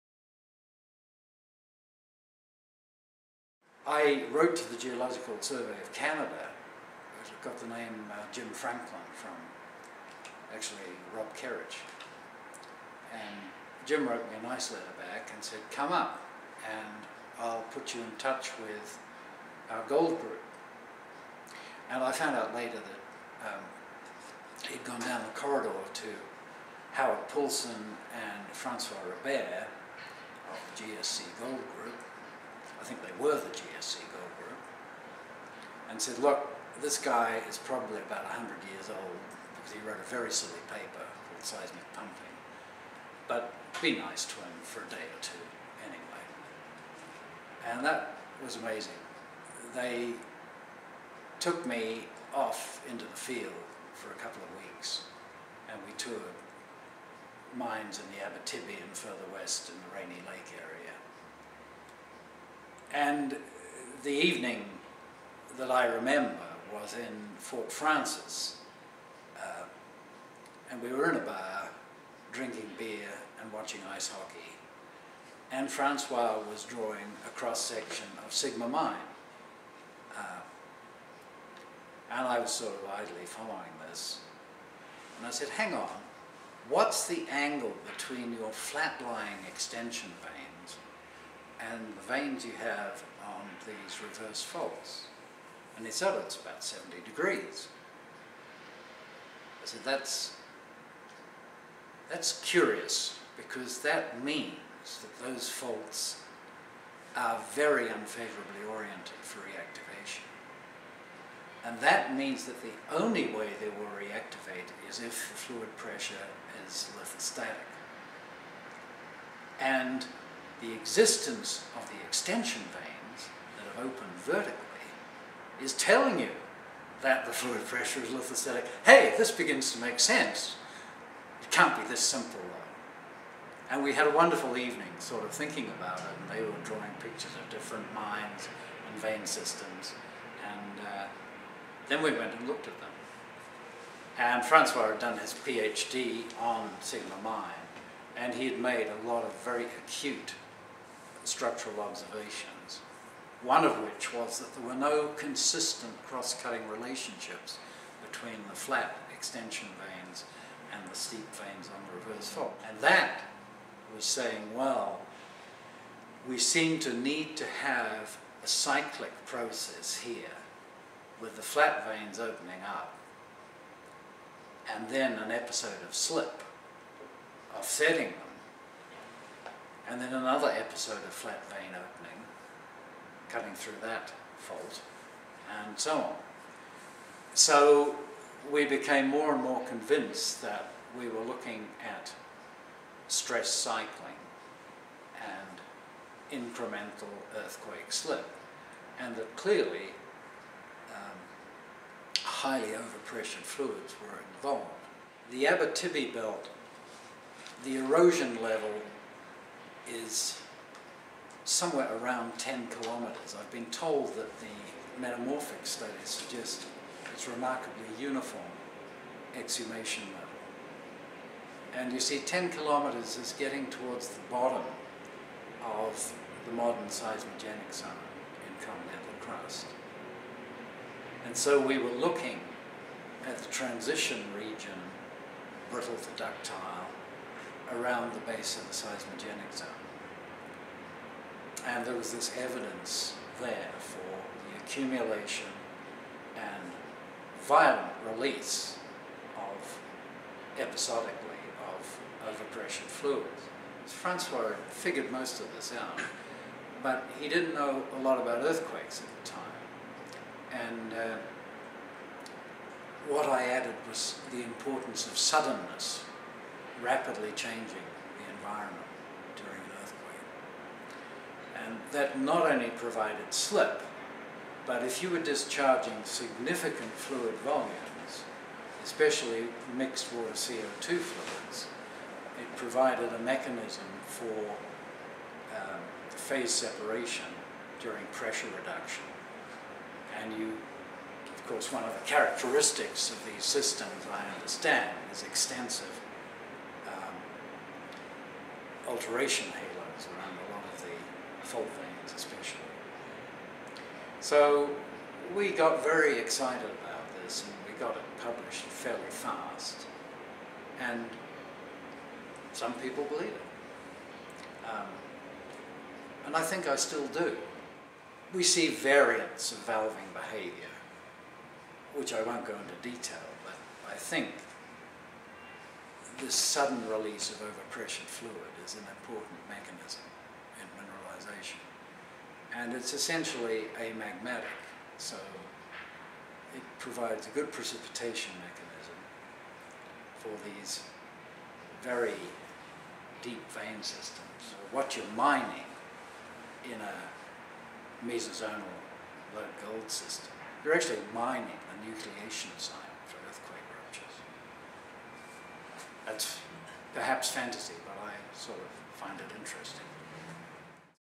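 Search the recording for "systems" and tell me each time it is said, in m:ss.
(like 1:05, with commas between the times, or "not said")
2:19, 4:53, 5:43, 5:49.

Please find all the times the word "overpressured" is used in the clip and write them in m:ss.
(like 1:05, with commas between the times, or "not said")
3:22, 4:12, 5:27.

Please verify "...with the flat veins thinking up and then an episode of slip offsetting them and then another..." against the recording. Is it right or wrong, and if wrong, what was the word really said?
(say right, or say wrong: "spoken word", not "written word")
wrong: "opening", not "thinking".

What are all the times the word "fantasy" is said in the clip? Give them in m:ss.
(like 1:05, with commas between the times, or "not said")
5:57.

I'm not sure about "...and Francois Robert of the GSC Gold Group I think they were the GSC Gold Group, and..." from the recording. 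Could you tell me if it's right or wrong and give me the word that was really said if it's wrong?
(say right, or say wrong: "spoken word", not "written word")
right.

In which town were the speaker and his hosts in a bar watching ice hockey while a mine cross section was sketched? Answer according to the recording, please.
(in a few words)
Fort Frances.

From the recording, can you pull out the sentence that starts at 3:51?
And so we were looking at the transition region, brittle to ductile, around the base of the seismogenic zone.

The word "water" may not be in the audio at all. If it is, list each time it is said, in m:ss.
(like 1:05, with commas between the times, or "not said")
4:40.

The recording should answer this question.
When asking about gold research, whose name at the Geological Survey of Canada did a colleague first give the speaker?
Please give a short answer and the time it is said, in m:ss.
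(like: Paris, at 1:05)
Jim Franklin, at 0:08.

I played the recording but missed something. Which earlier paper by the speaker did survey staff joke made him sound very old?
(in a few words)
Seismic Pumping.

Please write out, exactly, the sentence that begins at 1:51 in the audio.
And that means that the only way they will reactivate is if the fluid pressure is lithostatic.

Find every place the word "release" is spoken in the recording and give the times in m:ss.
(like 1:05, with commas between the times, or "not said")
4:08, 5:26.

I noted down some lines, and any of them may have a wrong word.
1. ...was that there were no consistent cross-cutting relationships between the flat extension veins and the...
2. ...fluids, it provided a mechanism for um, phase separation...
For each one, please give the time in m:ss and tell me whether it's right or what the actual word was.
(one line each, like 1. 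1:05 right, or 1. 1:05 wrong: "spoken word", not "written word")
1. 2:34 right
2. 4:40 right.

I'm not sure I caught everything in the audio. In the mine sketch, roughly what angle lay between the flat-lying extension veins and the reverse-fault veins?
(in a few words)
70 degrees.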